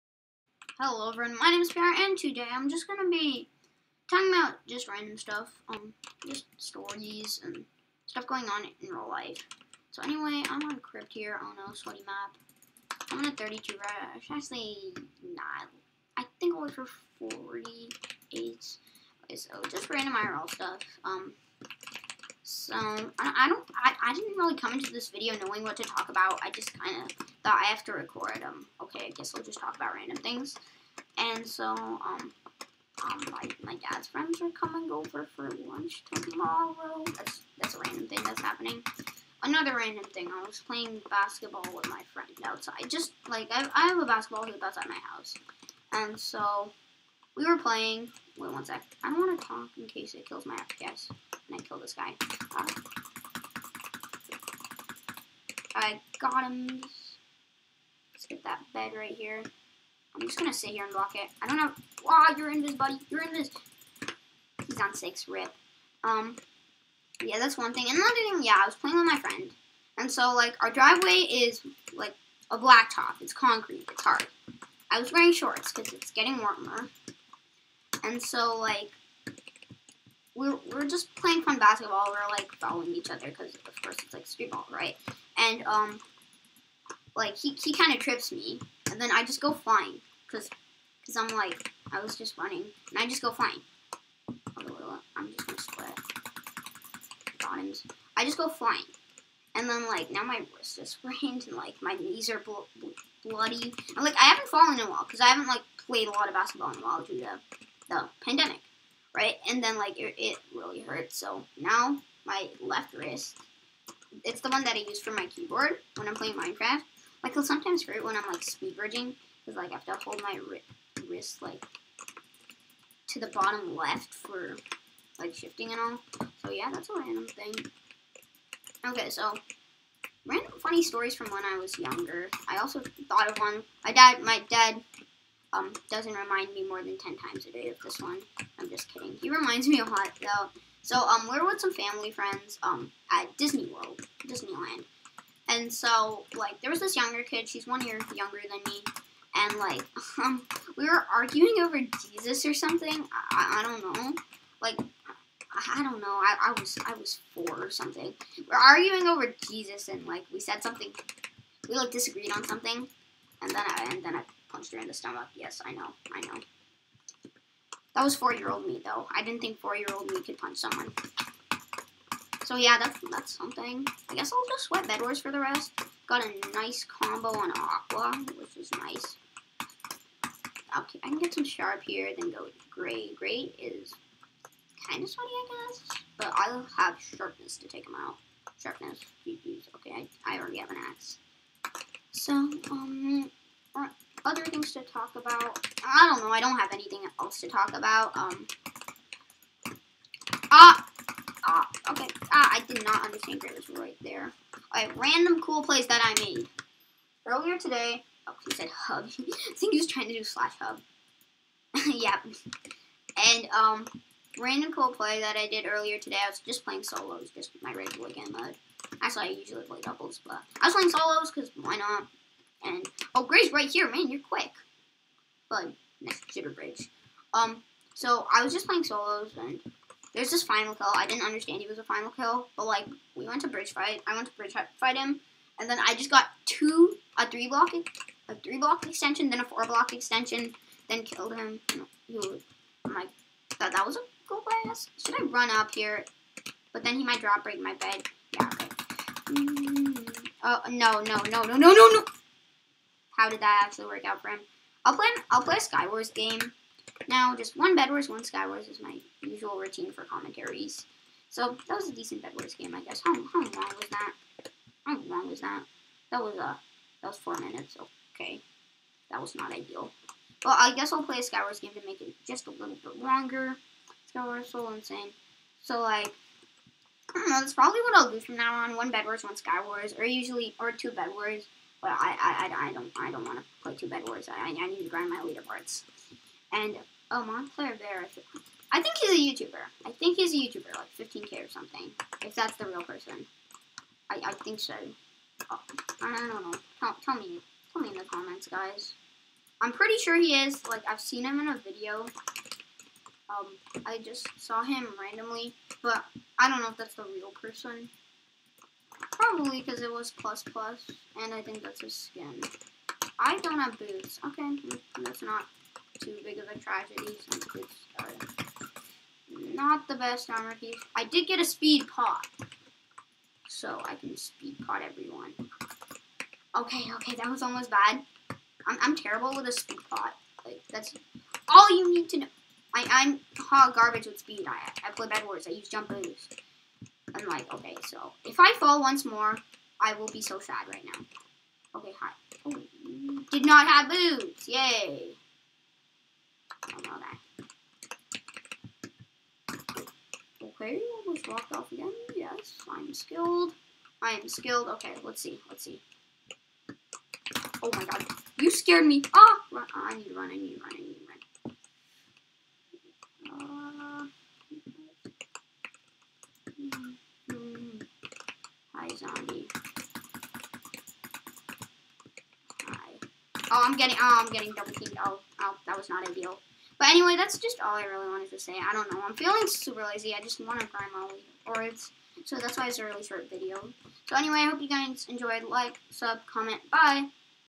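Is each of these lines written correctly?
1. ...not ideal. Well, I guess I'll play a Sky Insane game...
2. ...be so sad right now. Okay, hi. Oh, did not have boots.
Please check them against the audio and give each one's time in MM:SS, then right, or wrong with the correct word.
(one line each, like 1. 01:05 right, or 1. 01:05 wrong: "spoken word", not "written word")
1. 04:29 wrong: "Wars", not "Insane"
2. 05:40 right.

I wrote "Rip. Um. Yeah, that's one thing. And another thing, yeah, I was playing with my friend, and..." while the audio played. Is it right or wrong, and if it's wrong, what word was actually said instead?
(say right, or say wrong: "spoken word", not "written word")
right.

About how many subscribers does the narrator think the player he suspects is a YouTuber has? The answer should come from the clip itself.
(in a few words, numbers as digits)
15k.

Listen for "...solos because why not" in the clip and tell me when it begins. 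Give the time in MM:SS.
03:40.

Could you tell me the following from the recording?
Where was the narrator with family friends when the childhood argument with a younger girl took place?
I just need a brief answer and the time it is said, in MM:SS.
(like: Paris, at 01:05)
Disney World, at 02:23.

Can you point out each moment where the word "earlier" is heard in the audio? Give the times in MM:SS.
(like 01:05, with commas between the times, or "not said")
03:27, 03:35.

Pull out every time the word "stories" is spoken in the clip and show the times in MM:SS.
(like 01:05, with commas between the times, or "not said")
00:06, 02:10.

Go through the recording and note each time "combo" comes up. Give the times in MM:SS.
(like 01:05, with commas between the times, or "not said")
02:56.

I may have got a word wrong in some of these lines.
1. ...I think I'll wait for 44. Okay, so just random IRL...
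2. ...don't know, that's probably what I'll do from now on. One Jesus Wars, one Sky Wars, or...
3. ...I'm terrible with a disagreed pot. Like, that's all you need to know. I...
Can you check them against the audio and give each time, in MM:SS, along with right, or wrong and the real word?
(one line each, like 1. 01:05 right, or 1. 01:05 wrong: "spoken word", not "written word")
1. 00:16 wrong: "48", not "44"
2. 04:37 wrong: "Bed", not "Jesus"
3. 05:28 wrong: "speed", not "disagreed".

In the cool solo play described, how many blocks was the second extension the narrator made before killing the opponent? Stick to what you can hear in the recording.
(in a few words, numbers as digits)
4.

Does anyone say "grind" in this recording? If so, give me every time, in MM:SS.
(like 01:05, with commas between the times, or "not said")
04:44, 06:20.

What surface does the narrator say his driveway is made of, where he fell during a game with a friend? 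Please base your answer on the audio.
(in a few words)
Concrete.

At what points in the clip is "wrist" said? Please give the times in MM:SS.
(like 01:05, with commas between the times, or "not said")
01:40, 01:52, 02:01.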